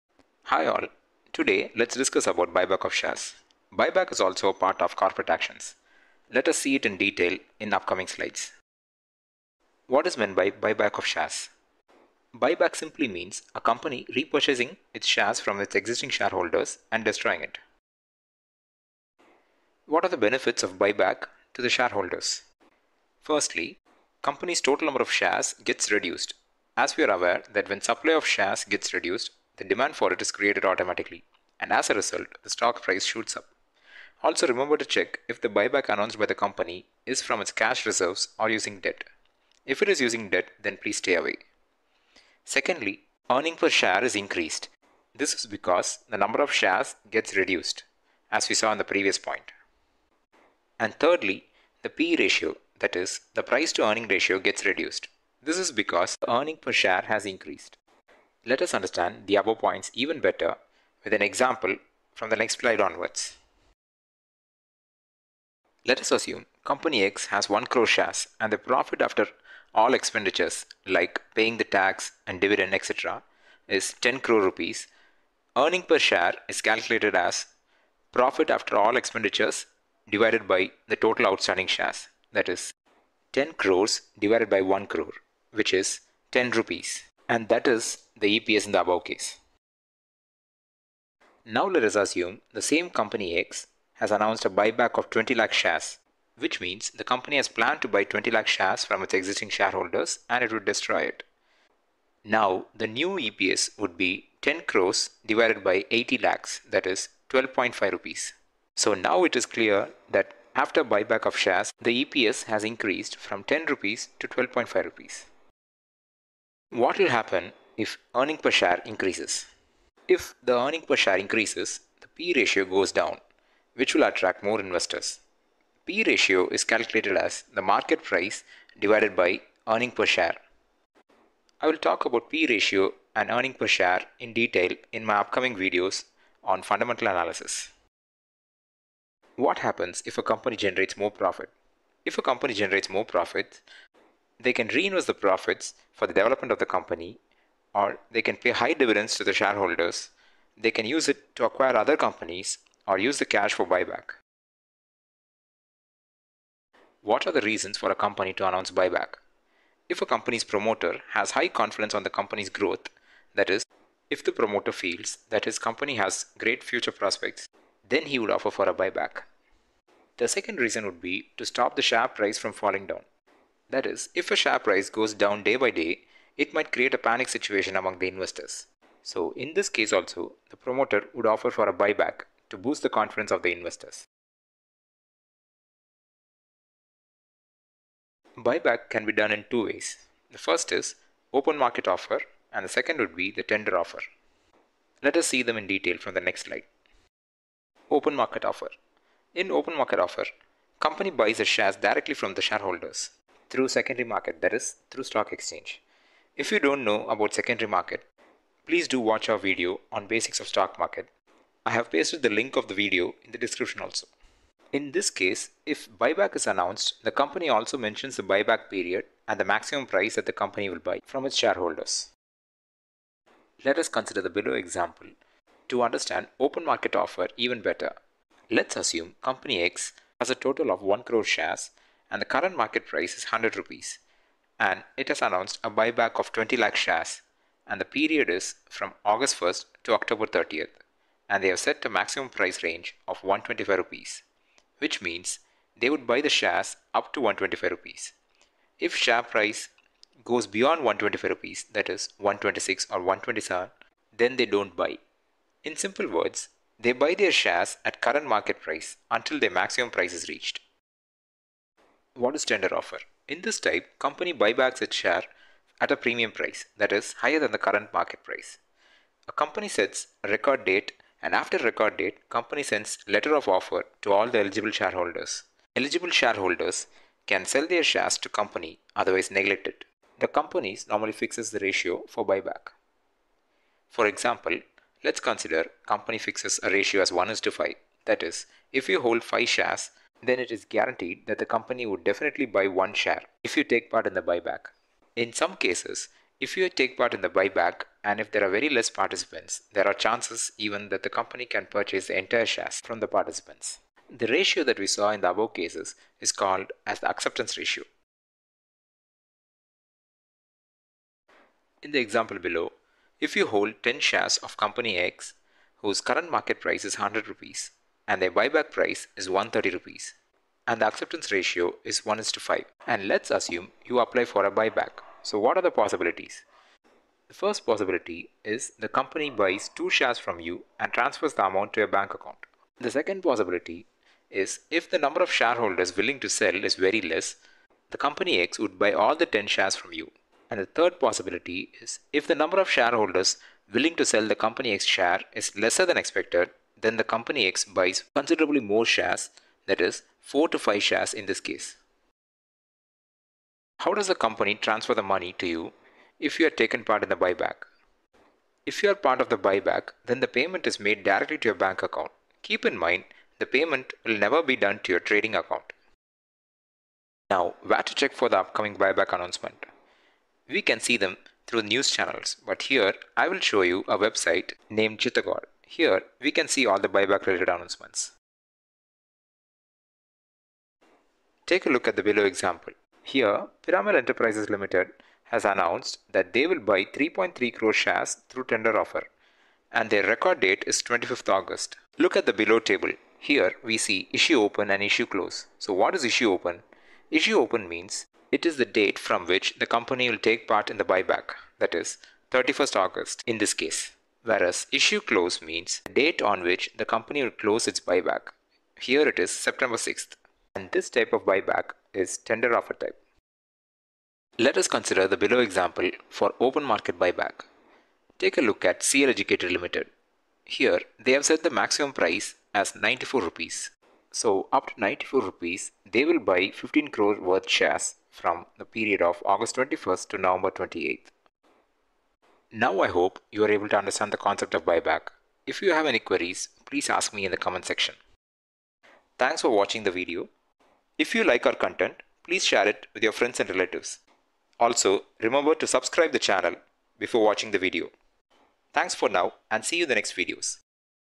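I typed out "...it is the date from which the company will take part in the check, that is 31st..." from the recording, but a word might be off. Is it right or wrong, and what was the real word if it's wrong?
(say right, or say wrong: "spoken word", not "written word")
wrong: "buyback", not "check".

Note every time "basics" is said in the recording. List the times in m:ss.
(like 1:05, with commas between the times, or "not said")
3:30.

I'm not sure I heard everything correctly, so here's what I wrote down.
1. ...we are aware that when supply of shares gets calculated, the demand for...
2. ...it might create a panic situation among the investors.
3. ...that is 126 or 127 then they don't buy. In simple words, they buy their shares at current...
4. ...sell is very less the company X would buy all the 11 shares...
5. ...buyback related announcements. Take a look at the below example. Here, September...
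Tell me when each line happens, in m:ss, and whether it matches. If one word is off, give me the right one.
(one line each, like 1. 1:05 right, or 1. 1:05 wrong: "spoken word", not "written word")
1. 0:26 wrong: "reduced", not "calculated"
2. 2:56 right
3. 4:11 right
4. 5:36 wrong: "10", not "11"
5. 6:16 wrong: "Piramal", not "September".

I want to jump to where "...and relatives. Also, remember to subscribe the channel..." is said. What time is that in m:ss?
7:23.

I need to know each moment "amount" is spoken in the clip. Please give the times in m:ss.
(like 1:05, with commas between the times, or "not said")
5:31.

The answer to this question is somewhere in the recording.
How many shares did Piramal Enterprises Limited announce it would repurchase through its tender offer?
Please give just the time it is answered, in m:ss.
6:26.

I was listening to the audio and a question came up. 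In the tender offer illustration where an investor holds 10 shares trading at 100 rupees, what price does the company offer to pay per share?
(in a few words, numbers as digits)
130 rupees.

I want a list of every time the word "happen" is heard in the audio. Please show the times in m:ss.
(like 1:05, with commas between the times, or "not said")
1:57, 2:19.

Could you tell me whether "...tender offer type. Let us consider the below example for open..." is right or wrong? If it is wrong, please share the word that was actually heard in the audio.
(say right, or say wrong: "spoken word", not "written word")
right.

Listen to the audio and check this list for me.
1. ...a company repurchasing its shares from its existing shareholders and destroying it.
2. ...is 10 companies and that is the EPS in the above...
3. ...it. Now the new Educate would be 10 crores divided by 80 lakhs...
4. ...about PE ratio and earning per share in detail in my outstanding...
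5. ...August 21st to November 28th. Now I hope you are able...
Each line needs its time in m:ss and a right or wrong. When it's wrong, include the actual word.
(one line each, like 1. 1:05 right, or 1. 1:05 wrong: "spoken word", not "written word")
1. 0:13 right
2. 1:25 wrong: "rupees", not "companies"
3. 1:41 wrong: "EPS", not "Educate"
4. 2:12 wrong: "upcoming", not "outstanding"
5. 7:09 right.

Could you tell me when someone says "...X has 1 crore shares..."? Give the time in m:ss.
1:07.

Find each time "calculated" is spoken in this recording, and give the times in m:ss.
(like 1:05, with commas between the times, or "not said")
1:16, 2:06.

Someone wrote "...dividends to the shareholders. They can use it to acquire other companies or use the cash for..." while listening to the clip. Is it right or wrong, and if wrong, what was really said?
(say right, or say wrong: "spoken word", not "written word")
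right.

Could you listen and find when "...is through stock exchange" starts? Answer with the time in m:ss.
3:24.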